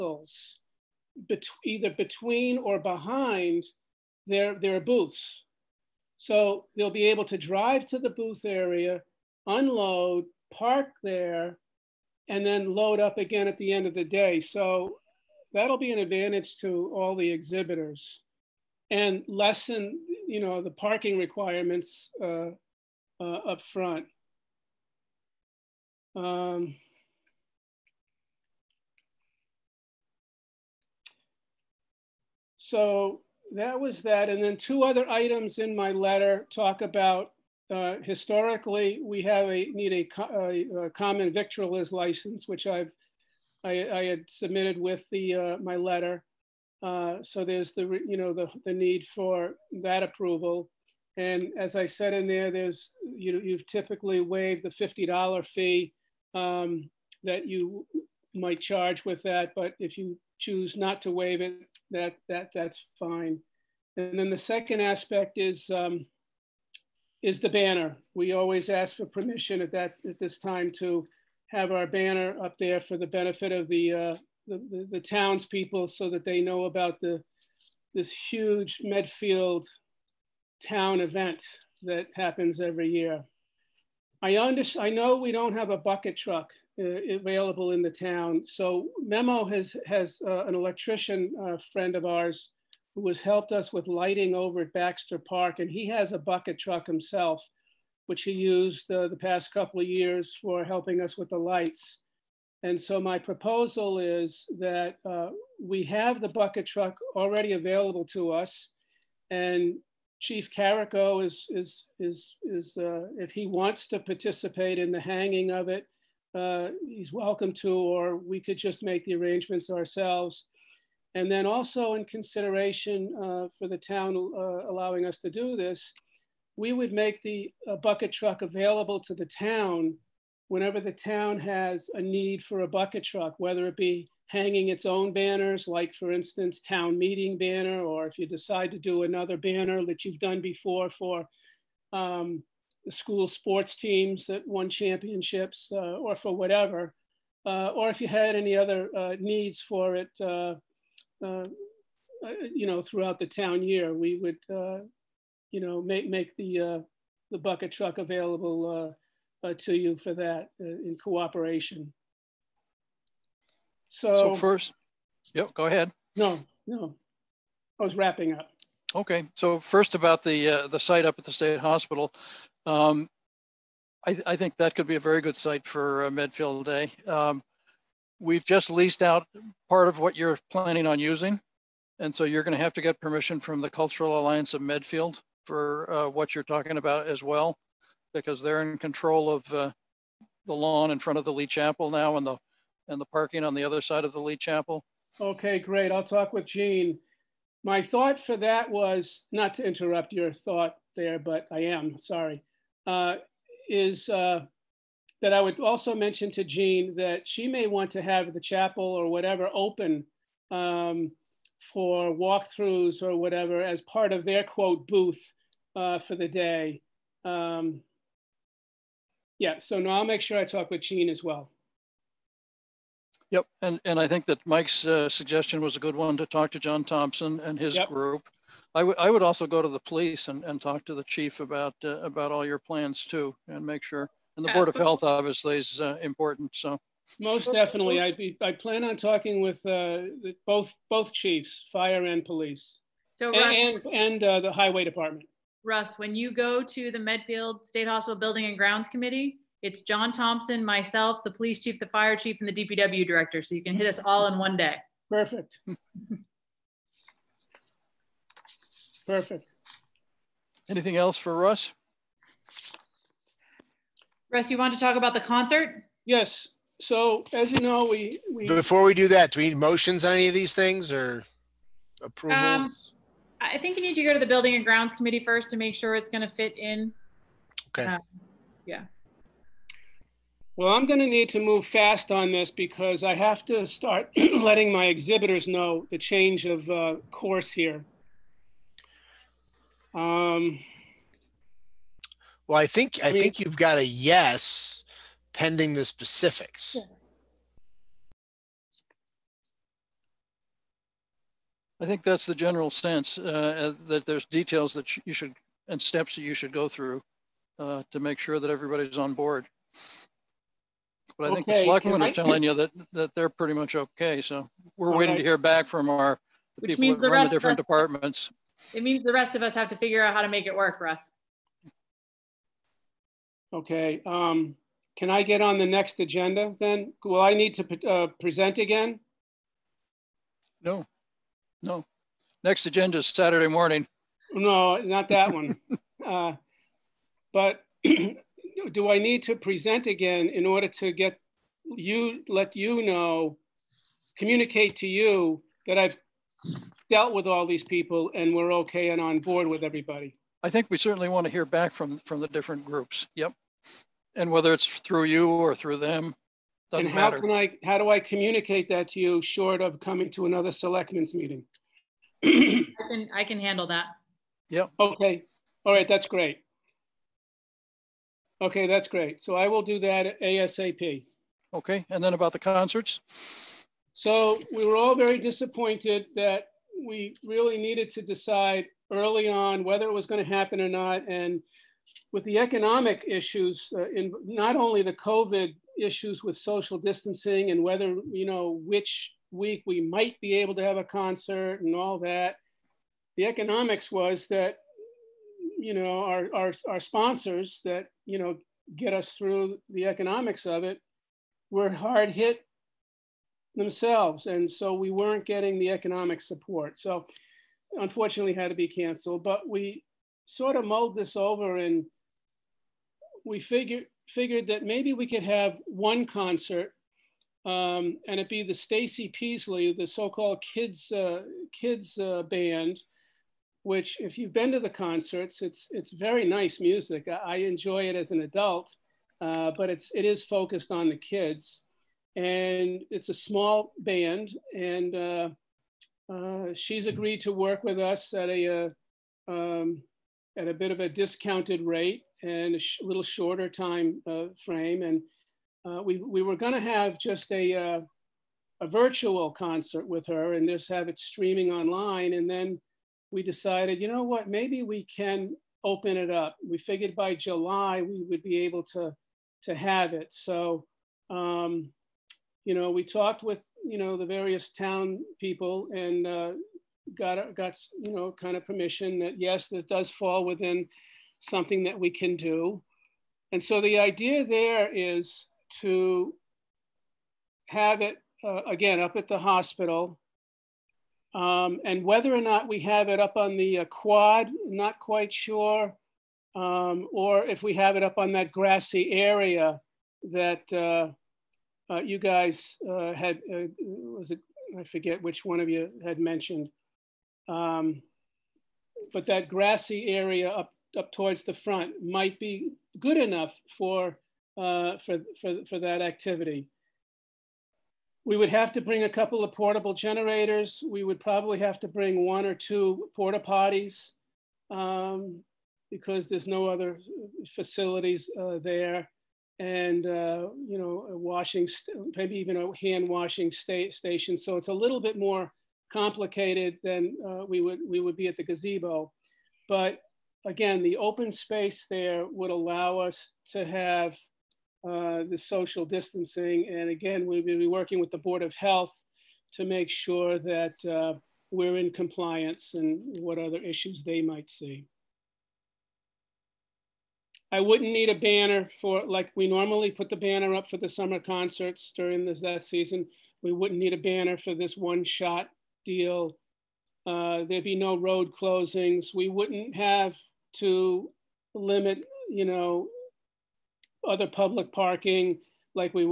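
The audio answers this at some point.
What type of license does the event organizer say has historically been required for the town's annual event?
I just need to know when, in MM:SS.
00:40.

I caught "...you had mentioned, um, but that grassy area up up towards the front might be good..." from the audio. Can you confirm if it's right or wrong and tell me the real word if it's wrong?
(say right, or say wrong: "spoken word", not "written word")
right.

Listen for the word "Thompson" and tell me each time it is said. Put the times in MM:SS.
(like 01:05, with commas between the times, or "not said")
03:46, 04:10.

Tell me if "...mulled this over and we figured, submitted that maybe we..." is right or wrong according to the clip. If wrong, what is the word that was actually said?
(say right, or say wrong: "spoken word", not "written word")
wrong: "figured", not "submitted".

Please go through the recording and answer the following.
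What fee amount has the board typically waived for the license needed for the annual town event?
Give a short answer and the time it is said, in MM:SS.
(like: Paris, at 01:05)
$50, at 00:54.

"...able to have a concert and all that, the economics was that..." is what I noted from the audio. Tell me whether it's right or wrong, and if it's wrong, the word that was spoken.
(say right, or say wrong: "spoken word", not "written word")
right.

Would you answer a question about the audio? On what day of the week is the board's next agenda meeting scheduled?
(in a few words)
Saturday.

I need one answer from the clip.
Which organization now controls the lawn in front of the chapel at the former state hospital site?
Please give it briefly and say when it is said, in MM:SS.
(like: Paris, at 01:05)
Cultural Alliance of Medfield, at 03:03.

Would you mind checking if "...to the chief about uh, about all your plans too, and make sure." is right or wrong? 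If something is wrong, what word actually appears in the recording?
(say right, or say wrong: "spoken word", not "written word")
right.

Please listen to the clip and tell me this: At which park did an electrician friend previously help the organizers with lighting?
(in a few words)
Baxter Park.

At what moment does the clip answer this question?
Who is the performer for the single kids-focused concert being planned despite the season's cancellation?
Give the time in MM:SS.
06:58.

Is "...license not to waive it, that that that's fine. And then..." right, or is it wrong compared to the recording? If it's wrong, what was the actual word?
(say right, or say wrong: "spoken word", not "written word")
wrong: "choose", not "license".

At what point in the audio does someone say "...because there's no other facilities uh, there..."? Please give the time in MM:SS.
08:35.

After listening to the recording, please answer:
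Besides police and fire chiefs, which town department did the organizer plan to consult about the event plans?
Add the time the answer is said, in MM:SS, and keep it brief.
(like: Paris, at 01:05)
highway department, at 04:04.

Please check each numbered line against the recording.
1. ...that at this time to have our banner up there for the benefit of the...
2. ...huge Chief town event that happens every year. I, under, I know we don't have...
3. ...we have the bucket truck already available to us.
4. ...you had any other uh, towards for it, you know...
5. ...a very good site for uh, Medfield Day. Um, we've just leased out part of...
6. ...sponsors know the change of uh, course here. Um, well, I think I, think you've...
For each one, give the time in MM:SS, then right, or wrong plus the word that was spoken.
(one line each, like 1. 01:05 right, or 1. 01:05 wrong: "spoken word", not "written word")
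1. 01:09 right
2. 01:18 wrong: "Medfield", not "Chief"
3. 01:45 right
4. 02:27 wrong: "needs", not "towards"
5. 02:54 right
6. 04:44 wrong: "exhibitors", not "sponsors".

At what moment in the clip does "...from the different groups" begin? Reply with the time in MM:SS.
05:52.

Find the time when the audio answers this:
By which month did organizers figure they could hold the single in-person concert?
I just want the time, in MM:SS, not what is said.
07:37.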